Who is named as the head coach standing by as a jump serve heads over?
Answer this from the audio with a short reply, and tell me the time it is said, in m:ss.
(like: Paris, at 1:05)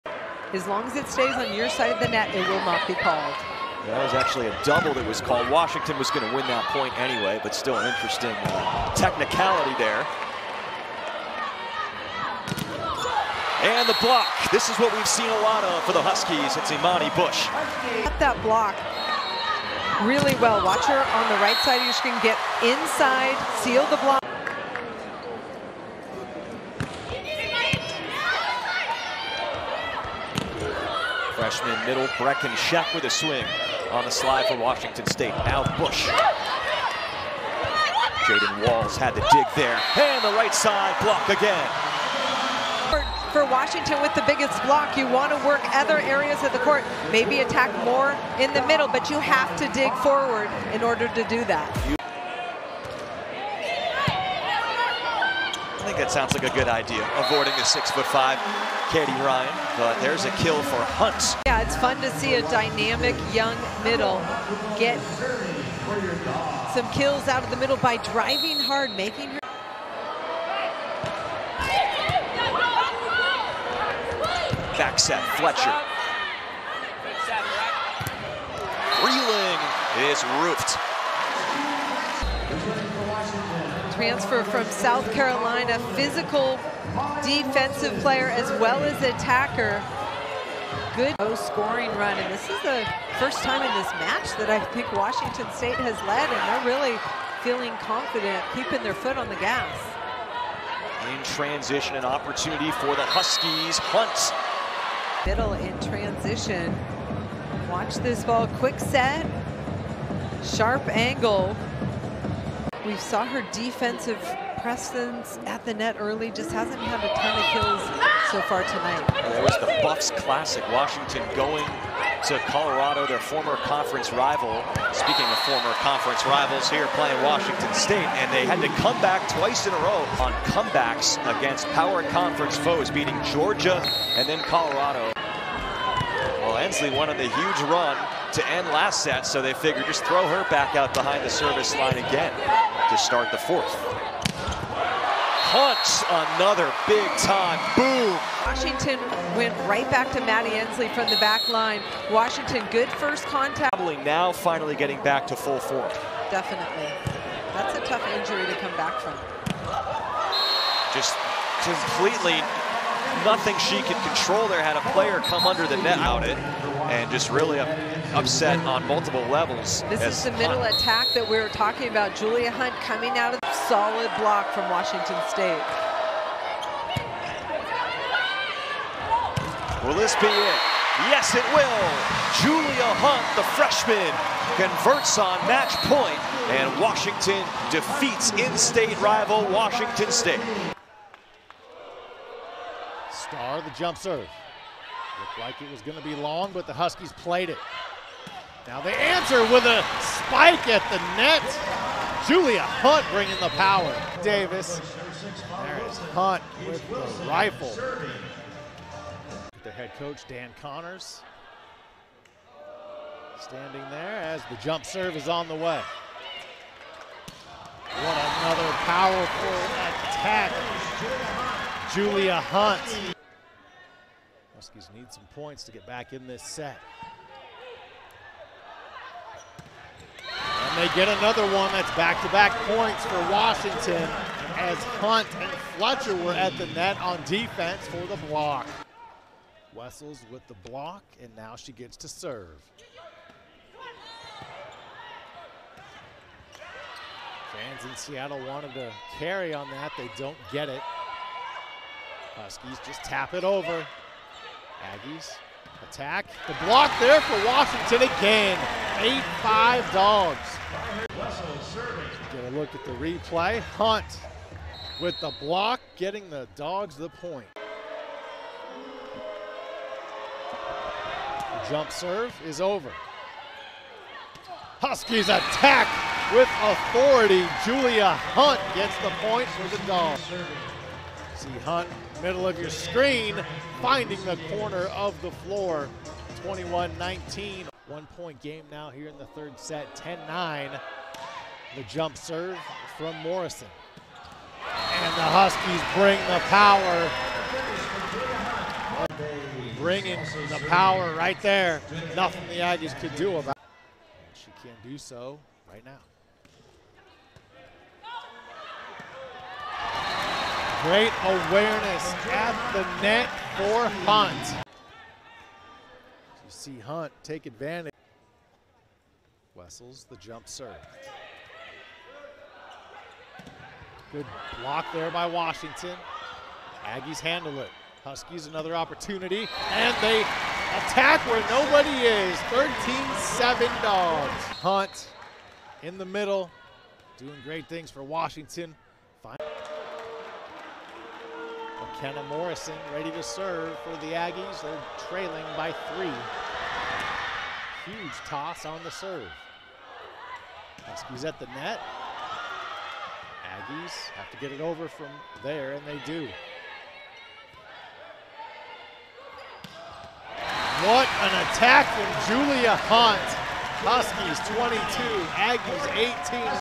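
Dan Conners, at 3:30.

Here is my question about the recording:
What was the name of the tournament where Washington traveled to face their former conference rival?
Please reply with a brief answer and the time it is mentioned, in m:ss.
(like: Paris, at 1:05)
Buffs Classic, at 1:59.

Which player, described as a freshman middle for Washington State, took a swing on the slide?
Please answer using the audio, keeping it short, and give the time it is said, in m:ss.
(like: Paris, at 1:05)
Brecken Sheck, at 0:32.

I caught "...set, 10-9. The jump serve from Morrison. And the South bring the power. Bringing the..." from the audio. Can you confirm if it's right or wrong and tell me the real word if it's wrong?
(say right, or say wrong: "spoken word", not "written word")
wrong: "Huskies", not "South".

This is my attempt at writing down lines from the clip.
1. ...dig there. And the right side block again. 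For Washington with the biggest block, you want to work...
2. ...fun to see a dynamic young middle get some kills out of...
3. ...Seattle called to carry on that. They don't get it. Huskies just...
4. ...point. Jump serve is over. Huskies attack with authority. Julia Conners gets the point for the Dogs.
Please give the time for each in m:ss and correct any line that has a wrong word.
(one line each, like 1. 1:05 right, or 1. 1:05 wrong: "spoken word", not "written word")
1. 0:39 right
2. 1:01 right
3. 4:07 wrong: "wanted", not "called"
4. 4:27 wrong: "Hunt", not "Conners".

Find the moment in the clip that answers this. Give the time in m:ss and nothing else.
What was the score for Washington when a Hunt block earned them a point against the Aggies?
4:18.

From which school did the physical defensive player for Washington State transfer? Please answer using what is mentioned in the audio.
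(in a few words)
South Carolina.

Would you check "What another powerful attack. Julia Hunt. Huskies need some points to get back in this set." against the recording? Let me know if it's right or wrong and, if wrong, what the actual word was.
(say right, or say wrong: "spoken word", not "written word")
right.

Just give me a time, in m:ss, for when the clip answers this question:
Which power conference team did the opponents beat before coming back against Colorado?
2:13.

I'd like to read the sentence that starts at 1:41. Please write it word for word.
In transition, an opportunity for the Huskies.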